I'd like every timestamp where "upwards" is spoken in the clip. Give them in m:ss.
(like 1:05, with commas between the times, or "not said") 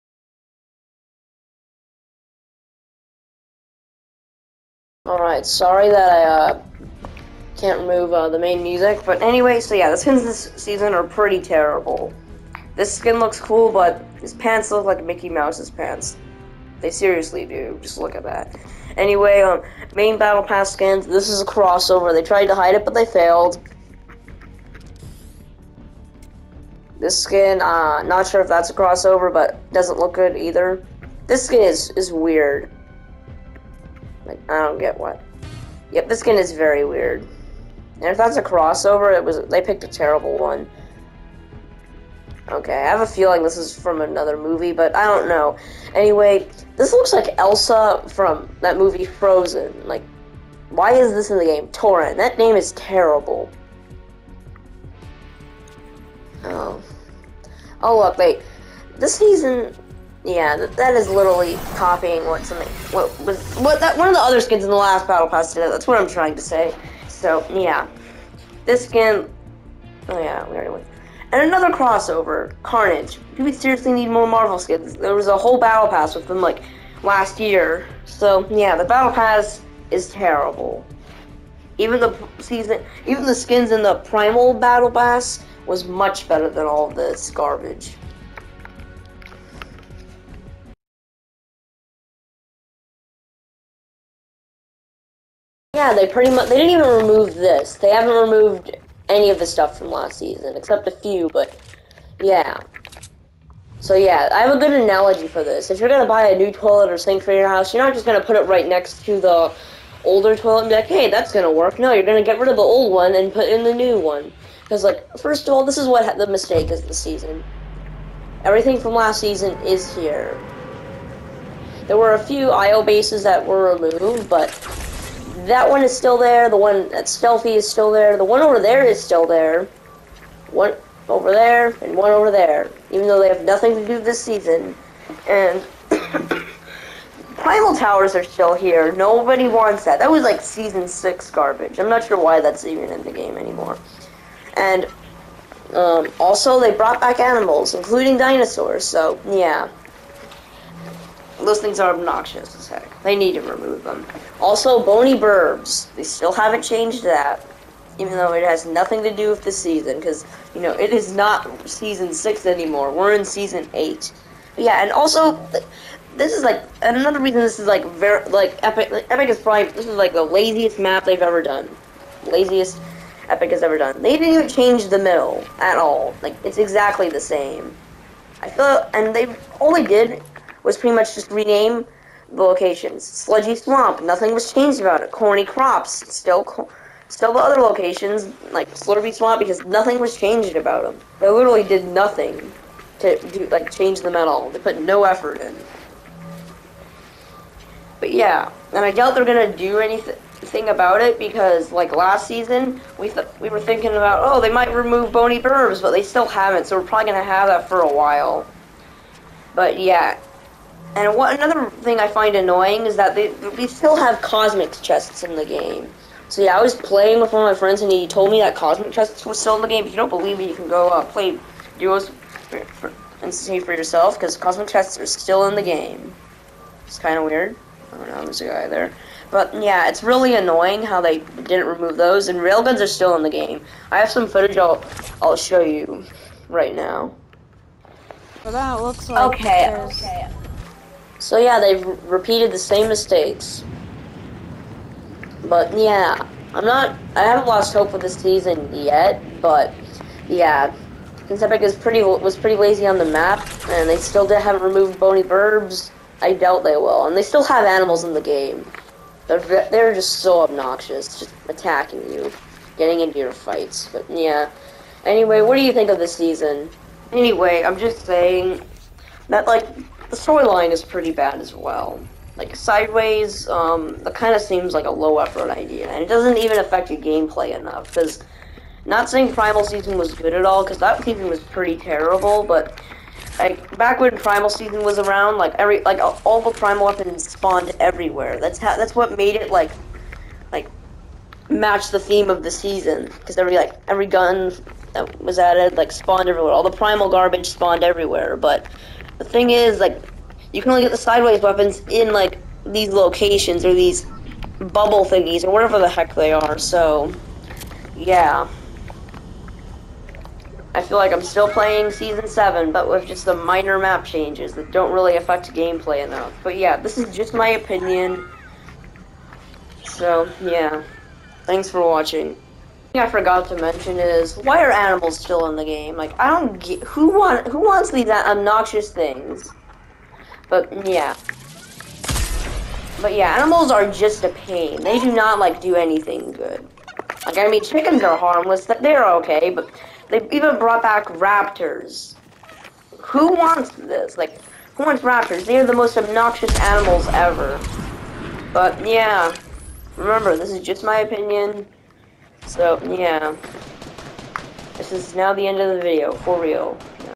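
not said.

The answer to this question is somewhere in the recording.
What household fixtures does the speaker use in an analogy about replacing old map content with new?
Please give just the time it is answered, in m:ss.
1:46.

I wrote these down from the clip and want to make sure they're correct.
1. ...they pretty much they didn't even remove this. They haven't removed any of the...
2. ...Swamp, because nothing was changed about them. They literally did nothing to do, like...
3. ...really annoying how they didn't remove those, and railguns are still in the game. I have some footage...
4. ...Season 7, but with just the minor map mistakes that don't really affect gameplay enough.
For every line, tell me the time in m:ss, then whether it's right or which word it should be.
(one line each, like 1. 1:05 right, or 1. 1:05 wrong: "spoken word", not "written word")
1. 1:35 right
2. 3:09 right
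3. 3:50 right
4. 5:11 wrong: "changes", not "mistakes".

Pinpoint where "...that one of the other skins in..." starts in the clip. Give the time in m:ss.
1:03.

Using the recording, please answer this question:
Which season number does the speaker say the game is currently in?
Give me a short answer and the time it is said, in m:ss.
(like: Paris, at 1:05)
8, at 2:43.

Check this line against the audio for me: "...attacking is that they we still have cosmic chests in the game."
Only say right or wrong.
wrong.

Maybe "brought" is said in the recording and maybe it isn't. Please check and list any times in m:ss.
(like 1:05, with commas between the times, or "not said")
2:26, 5:40.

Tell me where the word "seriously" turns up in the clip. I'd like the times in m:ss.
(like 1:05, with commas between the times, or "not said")
0:16, 1:13.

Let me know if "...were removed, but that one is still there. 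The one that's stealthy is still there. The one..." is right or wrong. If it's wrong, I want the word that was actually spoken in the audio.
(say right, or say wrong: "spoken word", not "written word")
right.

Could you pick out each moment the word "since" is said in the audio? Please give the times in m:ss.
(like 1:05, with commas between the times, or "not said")
4:11.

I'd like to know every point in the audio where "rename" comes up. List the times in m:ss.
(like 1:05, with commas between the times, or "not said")
3:01.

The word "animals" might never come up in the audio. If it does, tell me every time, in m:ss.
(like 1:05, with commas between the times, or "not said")
2:27, 4:17, 5:24, 5:33, 5:46.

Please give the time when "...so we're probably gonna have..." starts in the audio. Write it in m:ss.
3:26.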